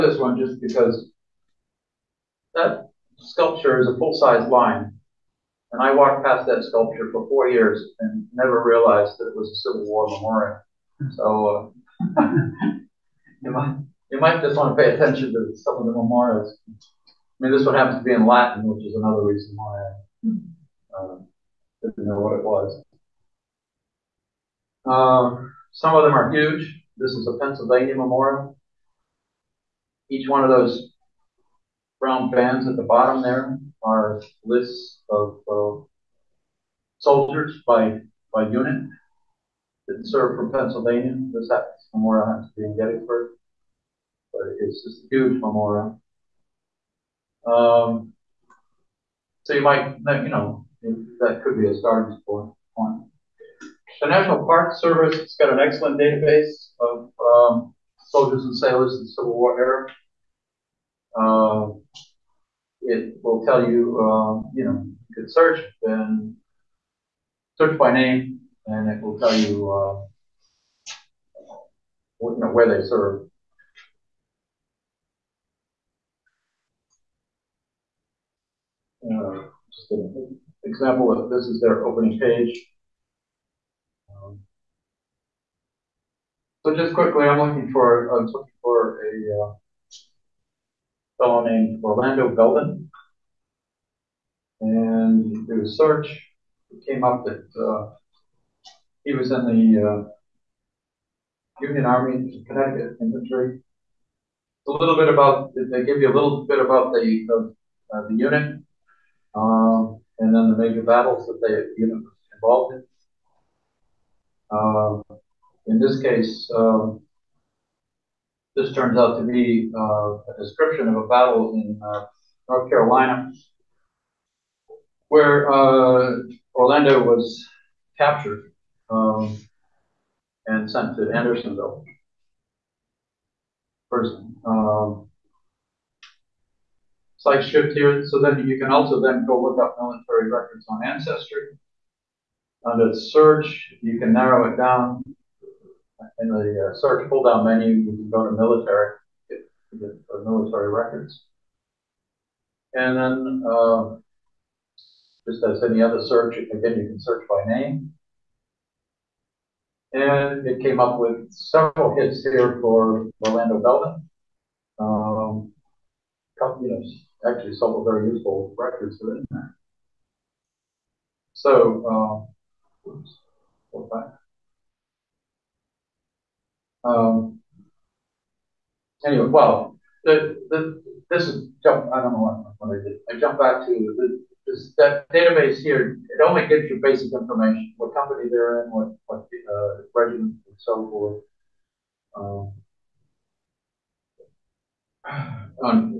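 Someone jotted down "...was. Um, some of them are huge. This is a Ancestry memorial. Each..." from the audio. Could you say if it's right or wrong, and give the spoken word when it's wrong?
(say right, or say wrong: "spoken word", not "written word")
wrong: "Pennsylvania", not "Ancestry".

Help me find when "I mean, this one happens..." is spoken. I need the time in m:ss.
0:16.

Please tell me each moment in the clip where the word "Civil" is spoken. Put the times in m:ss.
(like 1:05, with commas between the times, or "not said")
0:09, 0:59.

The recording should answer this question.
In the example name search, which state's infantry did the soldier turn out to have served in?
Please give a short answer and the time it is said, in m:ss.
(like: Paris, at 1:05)
Connecticut, at 1:42.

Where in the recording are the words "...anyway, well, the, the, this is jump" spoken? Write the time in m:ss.
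2:59.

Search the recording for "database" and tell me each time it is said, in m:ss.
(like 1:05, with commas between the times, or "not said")
0:55, 3:05.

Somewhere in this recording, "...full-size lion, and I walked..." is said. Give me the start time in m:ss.
0:03.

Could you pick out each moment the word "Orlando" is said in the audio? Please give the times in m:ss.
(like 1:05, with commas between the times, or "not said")
1:31, 2:06, 2:43.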